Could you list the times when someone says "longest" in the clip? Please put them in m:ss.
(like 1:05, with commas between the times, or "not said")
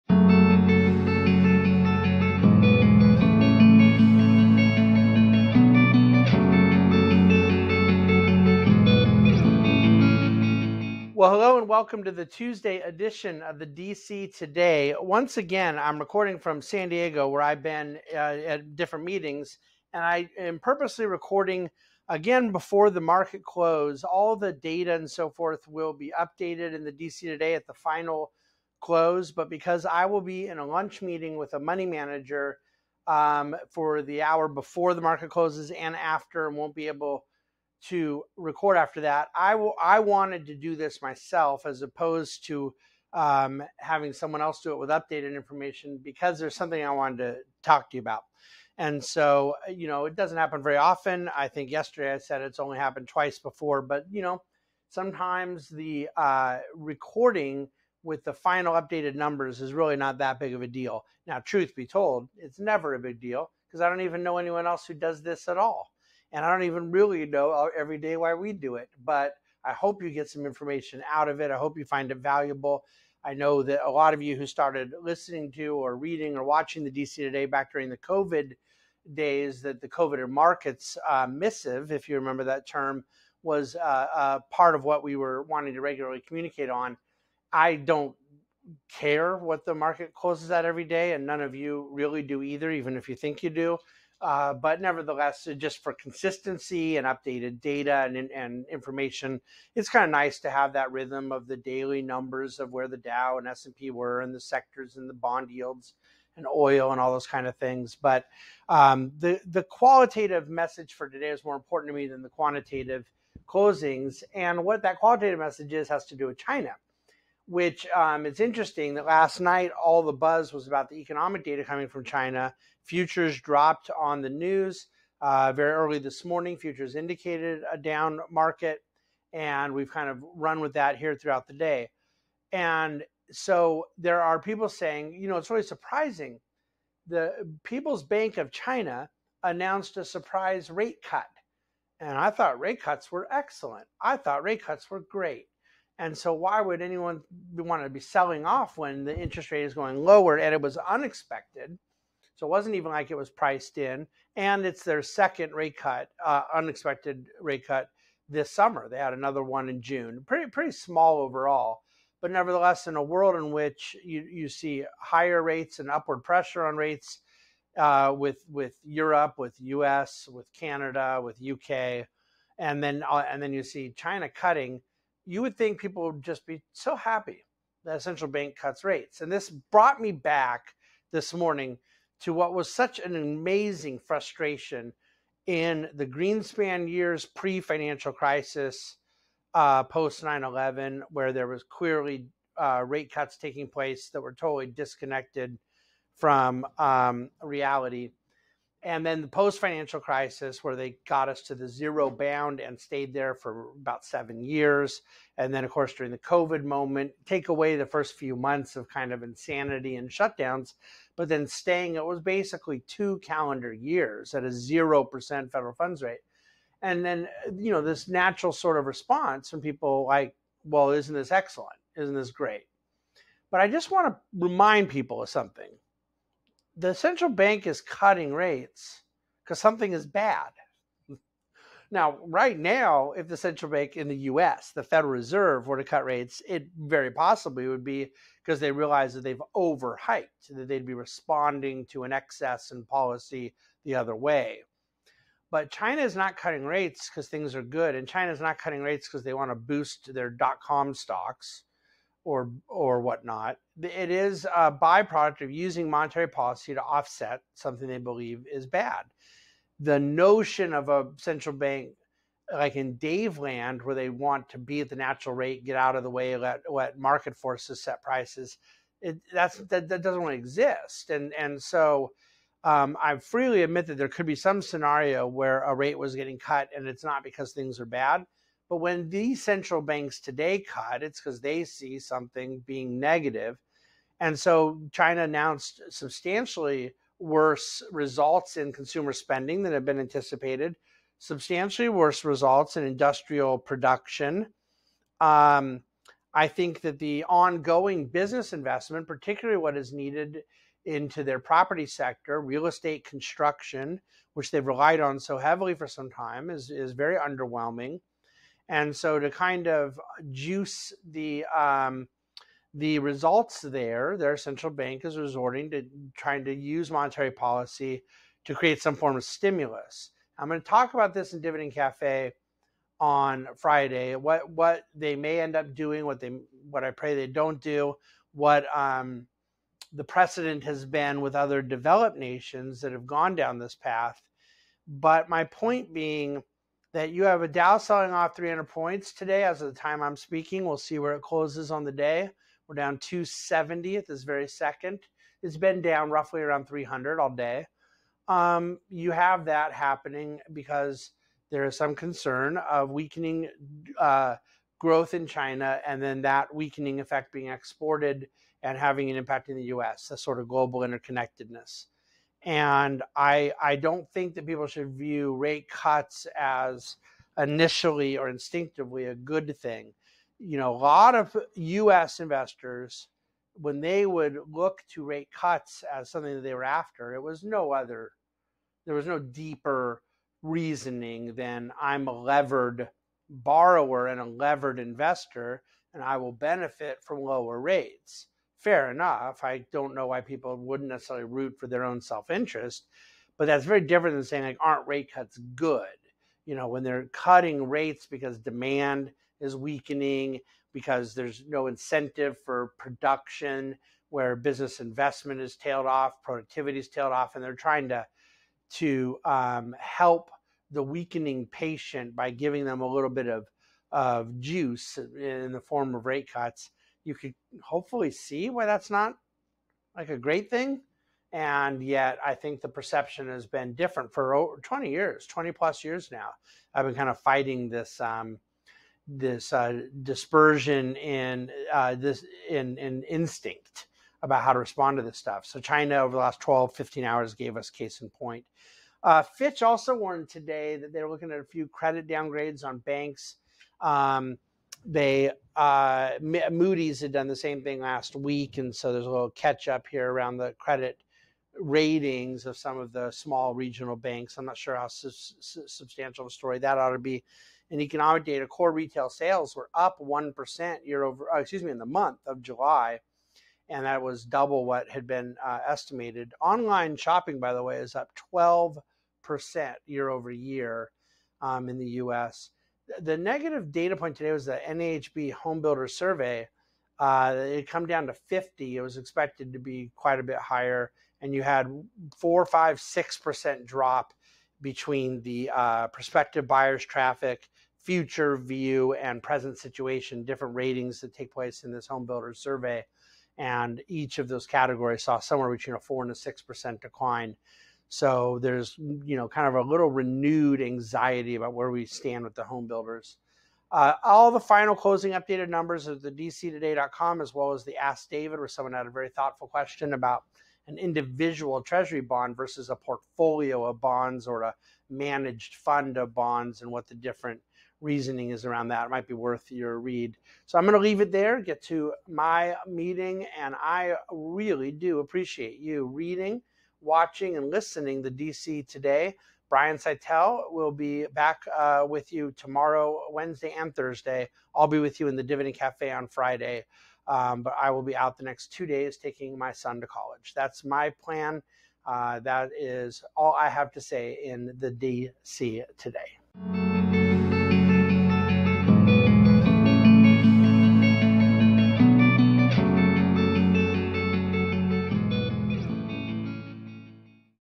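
not said.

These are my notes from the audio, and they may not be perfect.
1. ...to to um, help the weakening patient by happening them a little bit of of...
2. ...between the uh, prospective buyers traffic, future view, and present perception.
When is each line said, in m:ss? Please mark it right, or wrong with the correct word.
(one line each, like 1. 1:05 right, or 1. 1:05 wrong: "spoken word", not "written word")
1. 6:47 wrong: "giving", not "happening"
2. 8:04 wrong: "situation", not "perception".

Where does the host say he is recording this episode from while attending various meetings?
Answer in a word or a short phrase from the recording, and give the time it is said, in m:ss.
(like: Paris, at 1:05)
San Diego, at 0:16.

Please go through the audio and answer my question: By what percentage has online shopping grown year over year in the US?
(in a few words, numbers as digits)
12%.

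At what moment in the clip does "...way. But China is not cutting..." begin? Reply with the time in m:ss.
4:04.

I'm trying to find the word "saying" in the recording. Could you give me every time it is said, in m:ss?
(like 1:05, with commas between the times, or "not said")
2:14, 6:34.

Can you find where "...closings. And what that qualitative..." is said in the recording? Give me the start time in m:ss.
1:53.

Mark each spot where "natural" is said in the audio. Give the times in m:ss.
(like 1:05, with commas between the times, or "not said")
3:38, 4:24.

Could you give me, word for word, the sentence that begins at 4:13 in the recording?
It is a byproduct of using monetary policy to offset something they believe is bad.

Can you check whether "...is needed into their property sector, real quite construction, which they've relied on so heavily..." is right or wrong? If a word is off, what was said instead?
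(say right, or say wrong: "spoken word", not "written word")
wrong: "estate", not "quite".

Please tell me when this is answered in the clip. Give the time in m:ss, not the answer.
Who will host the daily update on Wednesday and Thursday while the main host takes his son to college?
8:49.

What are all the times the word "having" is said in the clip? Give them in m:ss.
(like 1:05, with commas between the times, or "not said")
0:43, 5:58.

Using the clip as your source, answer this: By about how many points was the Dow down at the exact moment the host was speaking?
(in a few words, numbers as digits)
270.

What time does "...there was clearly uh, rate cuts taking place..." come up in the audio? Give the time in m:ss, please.
3:11.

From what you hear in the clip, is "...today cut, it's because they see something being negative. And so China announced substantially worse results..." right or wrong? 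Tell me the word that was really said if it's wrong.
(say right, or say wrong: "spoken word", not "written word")
right.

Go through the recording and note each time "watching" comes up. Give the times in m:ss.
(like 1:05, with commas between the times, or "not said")
1:16, 8:46.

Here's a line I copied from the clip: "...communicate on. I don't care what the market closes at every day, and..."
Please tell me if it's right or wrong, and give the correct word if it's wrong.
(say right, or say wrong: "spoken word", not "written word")
right.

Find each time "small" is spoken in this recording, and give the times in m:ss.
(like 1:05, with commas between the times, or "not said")
2:40, 7:33.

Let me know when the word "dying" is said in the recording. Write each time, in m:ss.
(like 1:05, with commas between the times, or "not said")
not said.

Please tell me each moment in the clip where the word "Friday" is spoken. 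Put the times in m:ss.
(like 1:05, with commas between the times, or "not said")
5:23, 8:56.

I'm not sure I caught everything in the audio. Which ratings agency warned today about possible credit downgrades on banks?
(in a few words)
Fitch.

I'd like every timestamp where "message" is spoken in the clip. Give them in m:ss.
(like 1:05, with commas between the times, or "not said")
1:50, 1:55.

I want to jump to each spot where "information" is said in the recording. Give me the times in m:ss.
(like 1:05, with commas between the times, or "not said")
0:45, 1:10, 1:38.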